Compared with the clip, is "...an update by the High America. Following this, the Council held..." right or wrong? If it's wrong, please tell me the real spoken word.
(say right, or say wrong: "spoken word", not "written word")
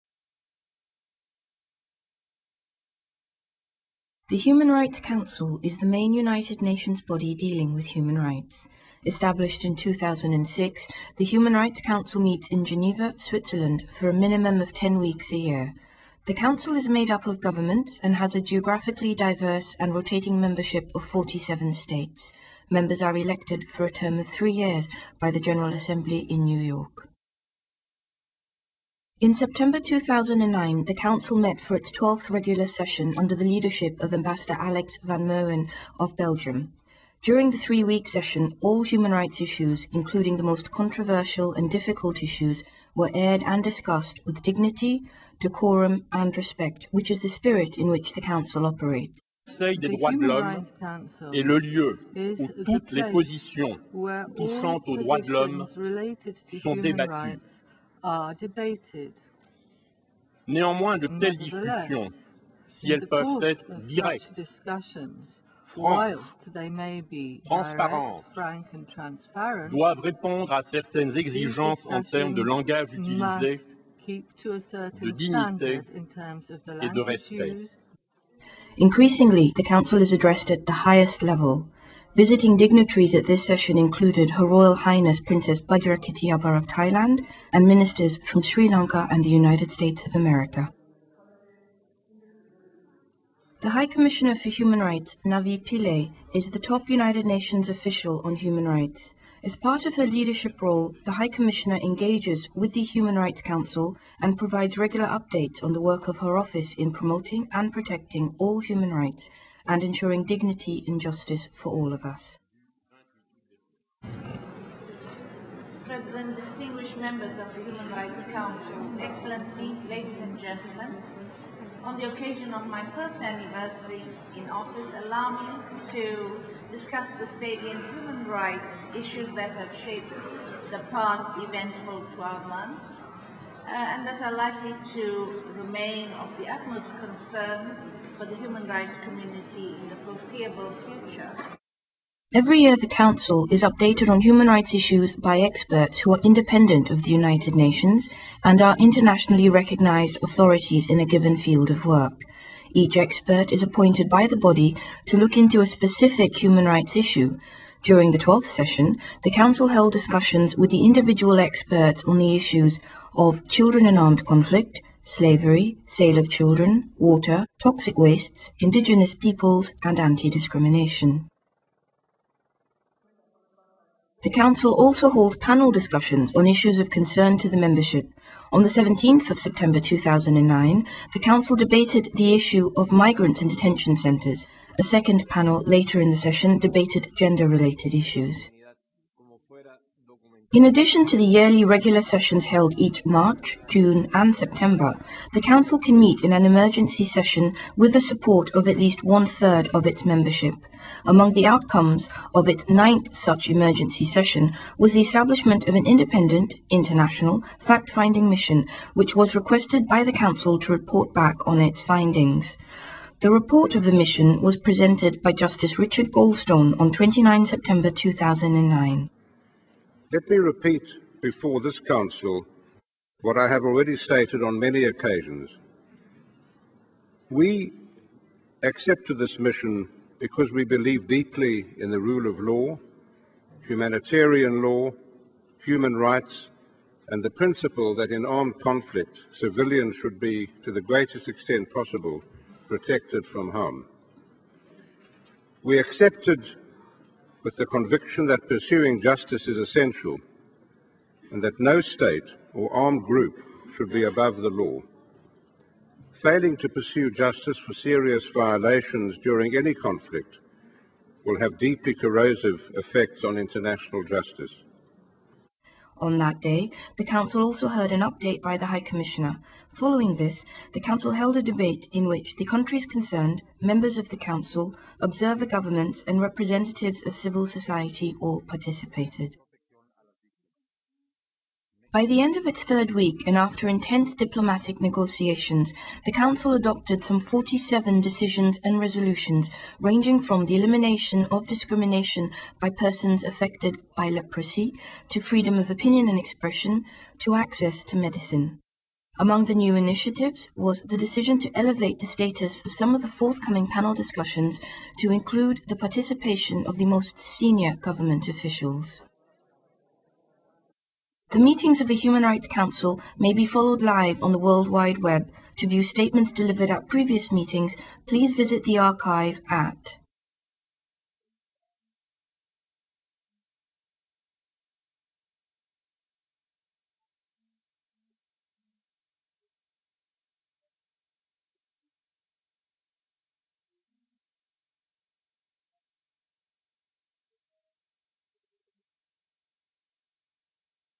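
wrong: "Commissioner", not "America".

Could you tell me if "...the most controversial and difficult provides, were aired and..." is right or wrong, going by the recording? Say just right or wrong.
wrong.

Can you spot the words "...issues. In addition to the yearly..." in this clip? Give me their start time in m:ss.
3:07.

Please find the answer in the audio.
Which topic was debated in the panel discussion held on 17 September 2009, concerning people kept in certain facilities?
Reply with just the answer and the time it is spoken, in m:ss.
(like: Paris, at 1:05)
migrants in detention centres, at 3:02.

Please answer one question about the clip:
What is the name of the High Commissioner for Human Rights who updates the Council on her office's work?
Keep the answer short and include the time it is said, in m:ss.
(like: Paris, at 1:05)
Navi Pillay, at 1:35.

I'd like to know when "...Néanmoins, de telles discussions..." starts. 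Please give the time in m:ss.
1:00.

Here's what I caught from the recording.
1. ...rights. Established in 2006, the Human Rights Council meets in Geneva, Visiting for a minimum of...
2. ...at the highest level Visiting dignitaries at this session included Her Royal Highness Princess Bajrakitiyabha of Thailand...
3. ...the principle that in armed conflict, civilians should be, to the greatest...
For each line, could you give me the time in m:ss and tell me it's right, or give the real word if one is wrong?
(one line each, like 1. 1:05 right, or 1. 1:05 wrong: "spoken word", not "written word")
1. 0:08 wrong: "Switzerland", not "Visiting"
2. 1:20 right
3. 3:57 right.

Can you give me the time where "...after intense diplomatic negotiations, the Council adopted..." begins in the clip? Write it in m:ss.
4:43.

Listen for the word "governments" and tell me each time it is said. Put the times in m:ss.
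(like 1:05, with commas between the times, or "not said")
0:17, 4:35, 5:07.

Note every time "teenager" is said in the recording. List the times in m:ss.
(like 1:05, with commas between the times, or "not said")
not said.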